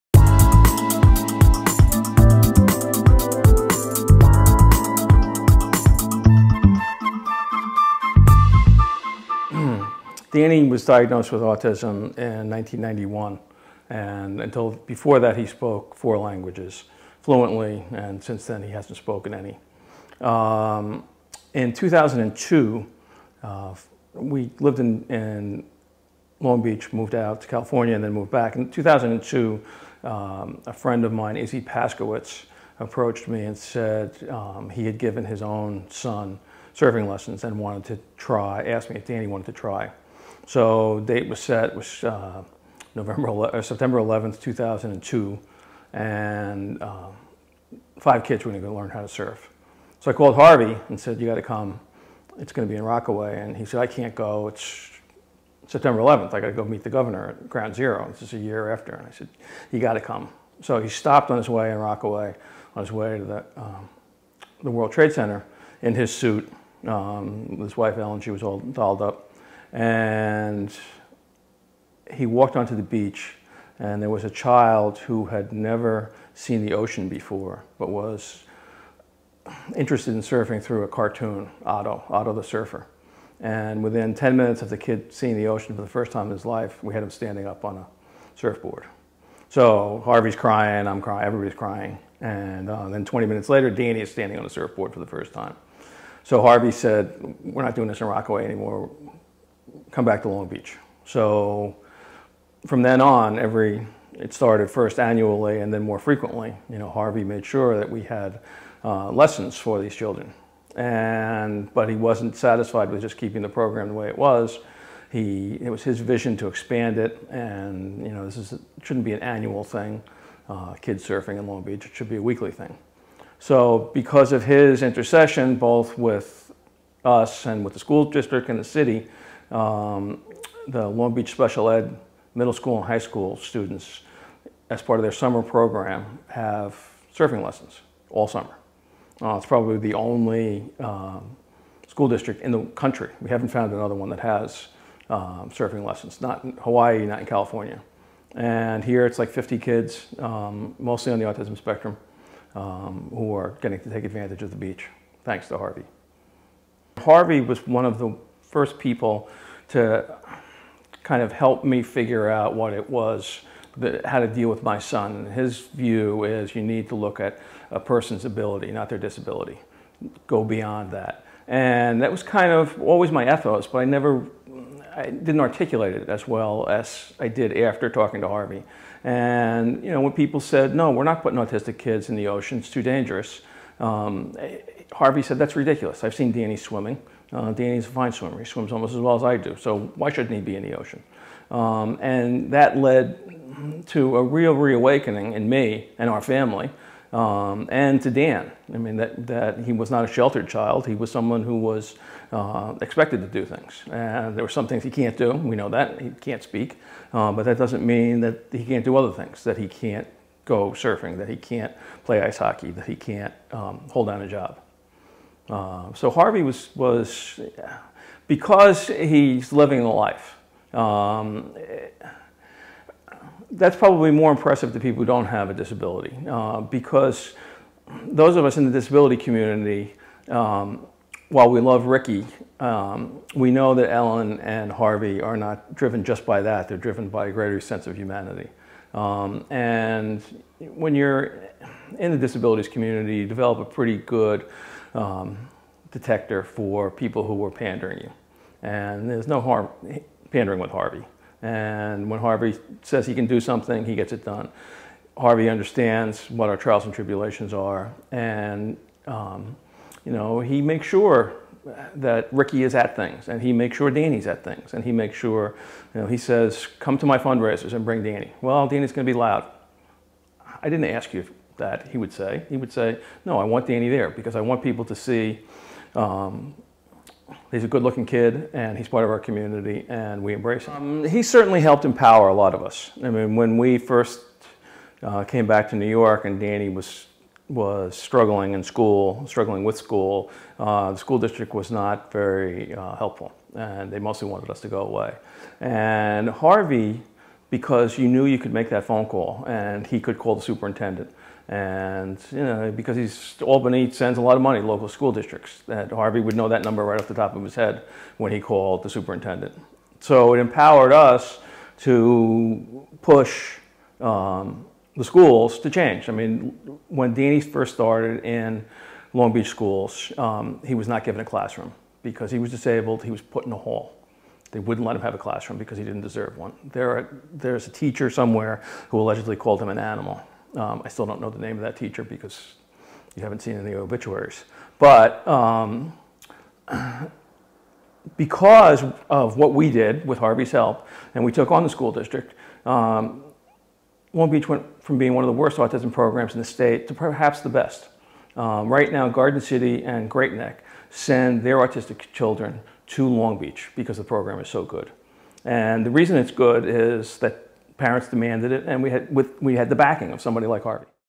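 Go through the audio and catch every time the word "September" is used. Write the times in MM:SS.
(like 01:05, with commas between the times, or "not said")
00:43, 00:55.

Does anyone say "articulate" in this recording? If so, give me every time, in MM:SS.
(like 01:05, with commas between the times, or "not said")
02:55.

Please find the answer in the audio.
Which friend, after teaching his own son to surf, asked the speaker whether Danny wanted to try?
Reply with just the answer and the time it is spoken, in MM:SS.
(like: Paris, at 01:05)
Izzy Paskowitz, at 00:31.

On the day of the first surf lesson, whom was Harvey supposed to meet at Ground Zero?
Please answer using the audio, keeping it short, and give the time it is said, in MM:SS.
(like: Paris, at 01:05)
The governor, at 00:56.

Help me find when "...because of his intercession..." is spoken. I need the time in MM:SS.
02:03.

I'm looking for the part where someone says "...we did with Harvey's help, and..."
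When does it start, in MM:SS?
05:39.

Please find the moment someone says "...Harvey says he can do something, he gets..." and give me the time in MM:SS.
04:12.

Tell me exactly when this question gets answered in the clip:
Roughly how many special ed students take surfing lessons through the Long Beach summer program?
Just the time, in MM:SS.
02:29.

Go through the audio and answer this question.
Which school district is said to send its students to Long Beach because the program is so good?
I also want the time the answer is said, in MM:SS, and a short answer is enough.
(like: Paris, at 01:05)
Garden City, at 05:49.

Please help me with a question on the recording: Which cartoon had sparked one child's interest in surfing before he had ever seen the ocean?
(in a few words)
Otto the Surfer.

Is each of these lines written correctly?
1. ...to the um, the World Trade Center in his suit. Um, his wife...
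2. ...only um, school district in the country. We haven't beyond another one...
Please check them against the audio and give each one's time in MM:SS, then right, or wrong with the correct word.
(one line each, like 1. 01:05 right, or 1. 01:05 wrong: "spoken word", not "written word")
1. 01:03 right
2. 02:19 wrong: "found", not "beyond".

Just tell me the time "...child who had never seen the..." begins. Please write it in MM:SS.
01:14.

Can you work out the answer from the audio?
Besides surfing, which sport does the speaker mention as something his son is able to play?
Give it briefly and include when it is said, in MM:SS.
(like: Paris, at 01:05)
Ice hockey, at 03:32.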